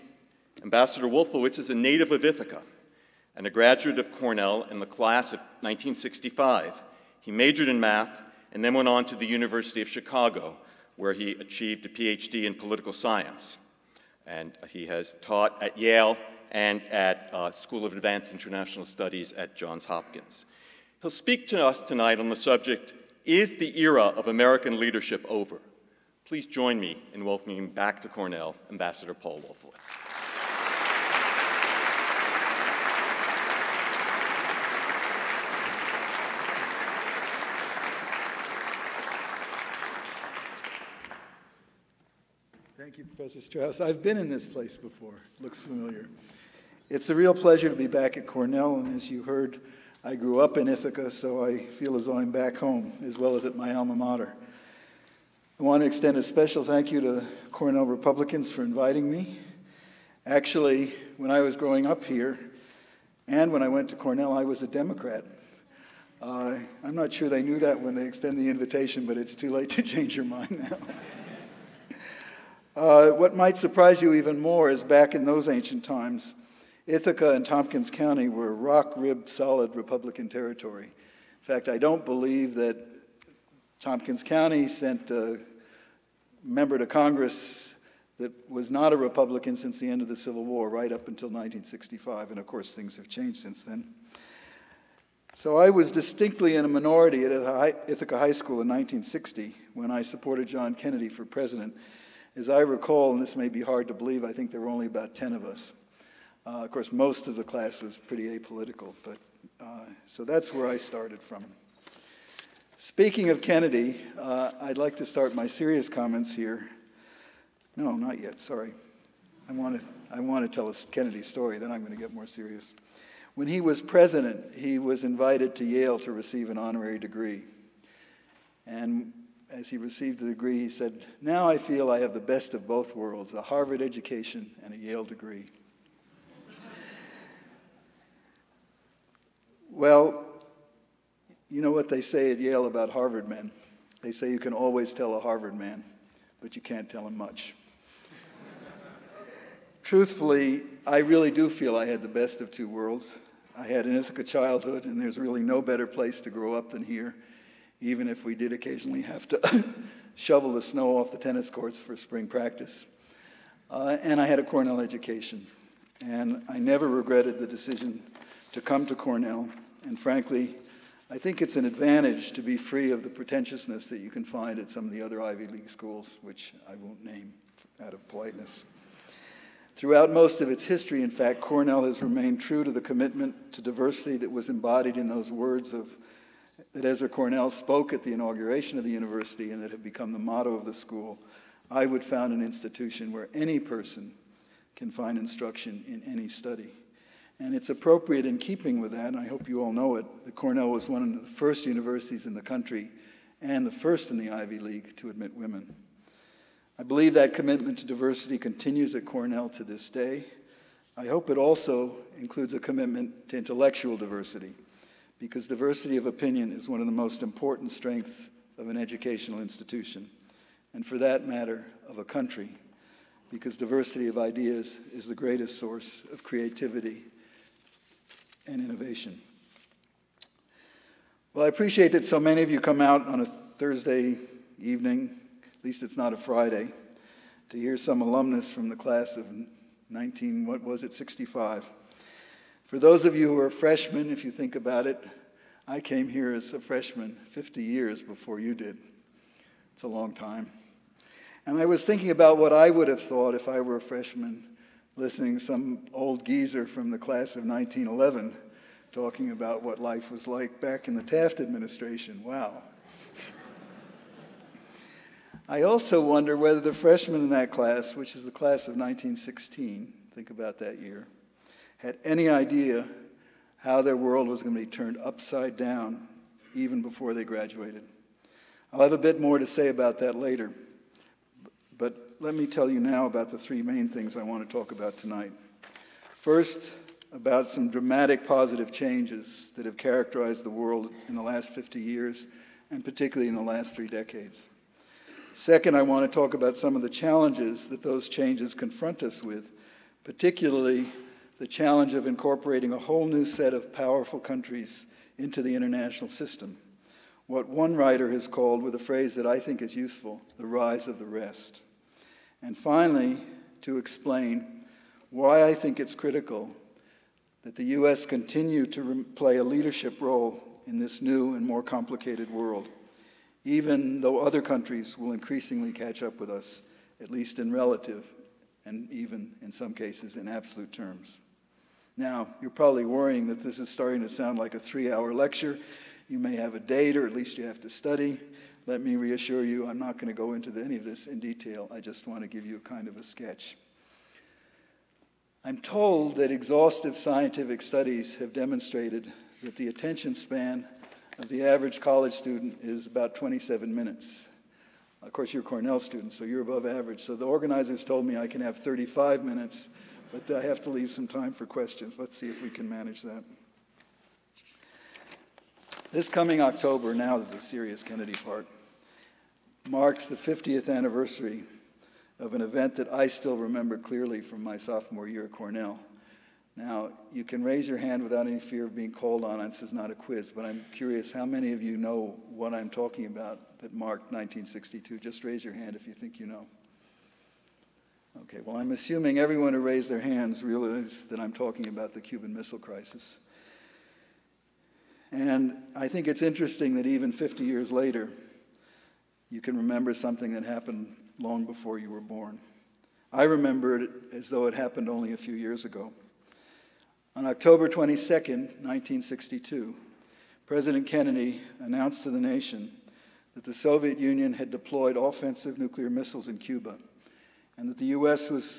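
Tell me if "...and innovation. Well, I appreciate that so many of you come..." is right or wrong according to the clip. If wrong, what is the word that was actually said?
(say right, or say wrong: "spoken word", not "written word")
right.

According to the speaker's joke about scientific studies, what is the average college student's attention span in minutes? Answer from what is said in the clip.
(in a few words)
27.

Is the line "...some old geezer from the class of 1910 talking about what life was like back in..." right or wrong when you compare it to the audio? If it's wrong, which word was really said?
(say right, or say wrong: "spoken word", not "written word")
wrong: "1911", not "1910".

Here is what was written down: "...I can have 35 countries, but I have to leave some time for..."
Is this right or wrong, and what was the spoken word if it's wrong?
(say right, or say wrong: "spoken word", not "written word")
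wrong: "minutes", not "countries".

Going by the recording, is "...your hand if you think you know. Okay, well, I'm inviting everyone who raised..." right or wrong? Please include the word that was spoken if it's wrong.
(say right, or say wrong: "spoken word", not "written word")
wrong: "assuming", not "inviting".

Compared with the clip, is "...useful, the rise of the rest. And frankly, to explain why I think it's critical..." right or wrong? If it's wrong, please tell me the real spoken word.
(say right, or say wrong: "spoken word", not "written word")
wrong: "finally", not "frankly".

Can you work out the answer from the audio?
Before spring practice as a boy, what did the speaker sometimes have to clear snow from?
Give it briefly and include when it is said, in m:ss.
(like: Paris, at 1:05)
tennis courts, at 2:41.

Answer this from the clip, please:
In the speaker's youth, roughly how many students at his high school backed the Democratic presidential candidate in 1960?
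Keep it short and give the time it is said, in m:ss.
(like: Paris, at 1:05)
10, at 1:44.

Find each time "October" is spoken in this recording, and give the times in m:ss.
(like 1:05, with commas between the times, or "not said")
6:06, 6:47.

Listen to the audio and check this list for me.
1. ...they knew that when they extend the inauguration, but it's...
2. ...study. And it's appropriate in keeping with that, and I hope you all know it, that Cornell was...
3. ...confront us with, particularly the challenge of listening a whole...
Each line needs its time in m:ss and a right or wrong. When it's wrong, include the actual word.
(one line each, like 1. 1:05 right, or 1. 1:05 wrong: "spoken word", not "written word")
1. 1:07 wrong: "invitation", not "inauguration"
2. 3:16 right
3. 4:58 wrong: "incorporating", not "listening".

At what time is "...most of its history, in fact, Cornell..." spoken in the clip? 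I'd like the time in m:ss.
3:00.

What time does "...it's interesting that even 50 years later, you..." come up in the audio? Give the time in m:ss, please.
6:36.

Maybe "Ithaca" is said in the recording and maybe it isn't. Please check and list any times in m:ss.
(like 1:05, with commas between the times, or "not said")
0:02, 0:50, 1:16, 1:37, 2:33.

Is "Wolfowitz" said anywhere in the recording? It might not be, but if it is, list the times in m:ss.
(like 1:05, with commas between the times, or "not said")
0:01, 0:29.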